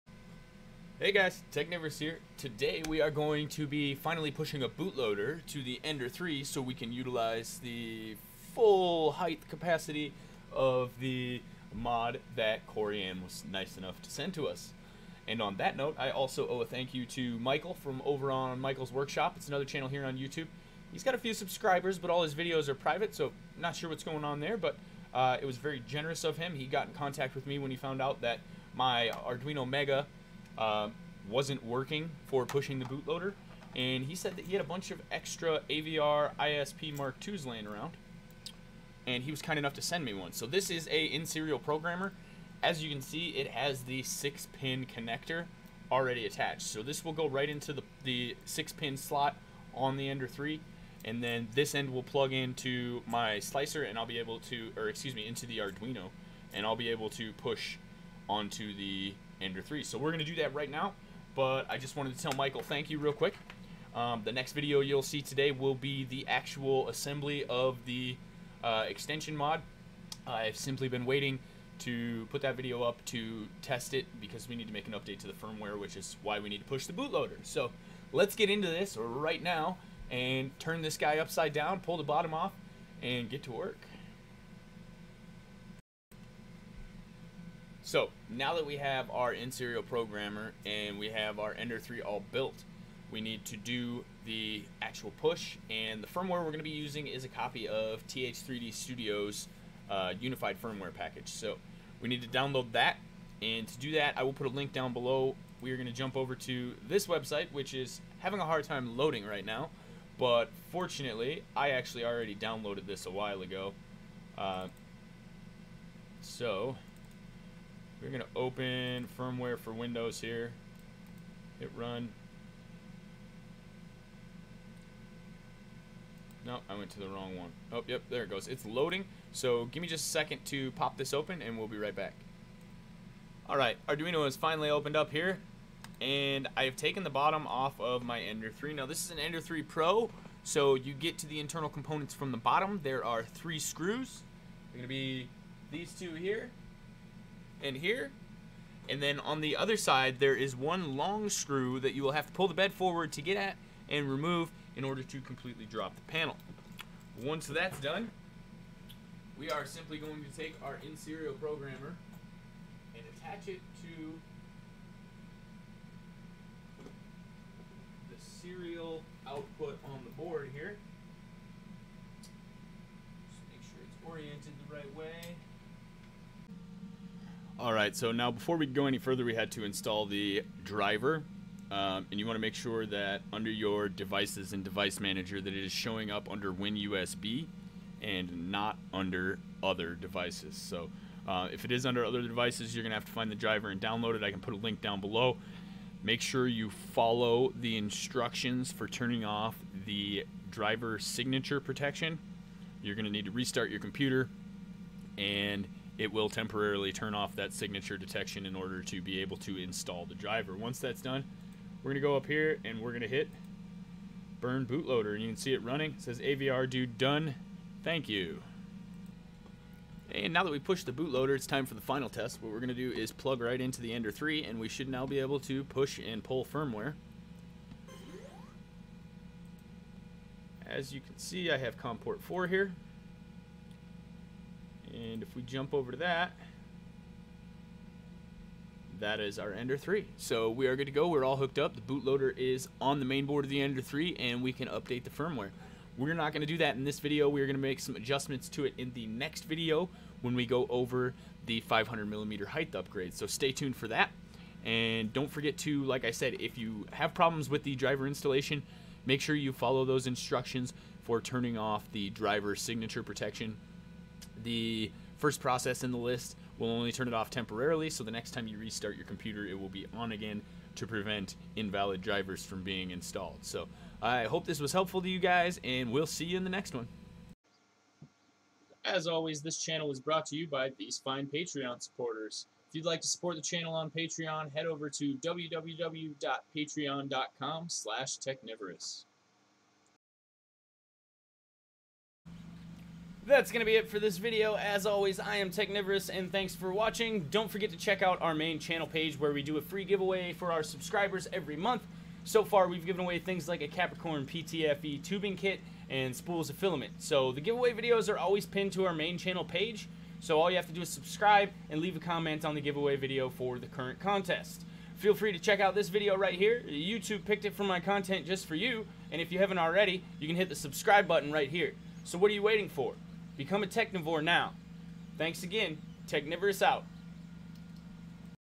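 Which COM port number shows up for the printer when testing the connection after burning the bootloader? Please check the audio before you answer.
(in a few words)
4.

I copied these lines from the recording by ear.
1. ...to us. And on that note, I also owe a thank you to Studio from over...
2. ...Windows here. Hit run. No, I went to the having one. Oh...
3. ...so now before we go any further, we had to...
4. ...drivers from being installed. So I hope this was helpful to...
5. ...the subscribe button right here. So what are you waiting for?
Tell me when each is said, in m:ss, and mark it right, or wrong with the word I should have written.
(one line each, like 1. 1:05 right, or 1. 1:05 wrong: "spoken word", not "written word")
1. 0:14 wrong: "Michael", not "Studio"
2. 1:59 wrong: "wrong", not "having"
3. 2:57 right
4. 4:32 right
5. 5:20 right.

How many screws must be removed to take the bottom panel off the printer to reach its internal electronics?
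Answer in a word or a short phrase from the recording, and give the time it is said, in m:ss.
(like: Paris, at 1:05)
3, at 2:23.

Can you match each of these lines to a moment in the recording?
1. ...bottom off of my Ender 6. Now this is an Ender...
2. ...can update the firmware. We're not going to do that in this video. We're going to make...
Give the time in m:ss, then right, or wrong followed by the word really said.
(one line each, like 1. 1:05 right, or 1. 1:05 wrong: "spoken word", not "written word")
1. 2:17 wrong: "3", not "6"
2. 4:04 right.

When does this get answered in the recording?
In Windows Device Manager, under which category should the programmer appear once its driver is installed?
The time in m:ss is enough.
3:06.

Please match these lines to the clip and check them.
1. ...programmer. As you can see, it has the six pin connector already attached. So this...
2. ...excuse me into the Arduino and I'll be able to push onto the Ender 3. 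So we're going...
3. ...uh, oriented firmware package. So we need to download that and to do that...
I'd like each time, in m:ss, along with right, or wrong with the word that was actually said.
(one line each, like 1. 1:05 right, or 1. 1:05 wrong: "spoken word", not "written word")
1. 0:41 right
2. 0:54 right
3. 1:39 wrong: "unified", not "oriented".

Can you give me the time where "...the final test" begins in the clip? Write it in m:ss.
3:41.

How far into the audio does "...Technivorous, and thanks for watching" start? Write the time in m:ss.
4:55.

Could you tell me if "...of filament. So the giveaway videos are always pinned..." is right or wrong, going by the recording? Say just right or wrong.
right.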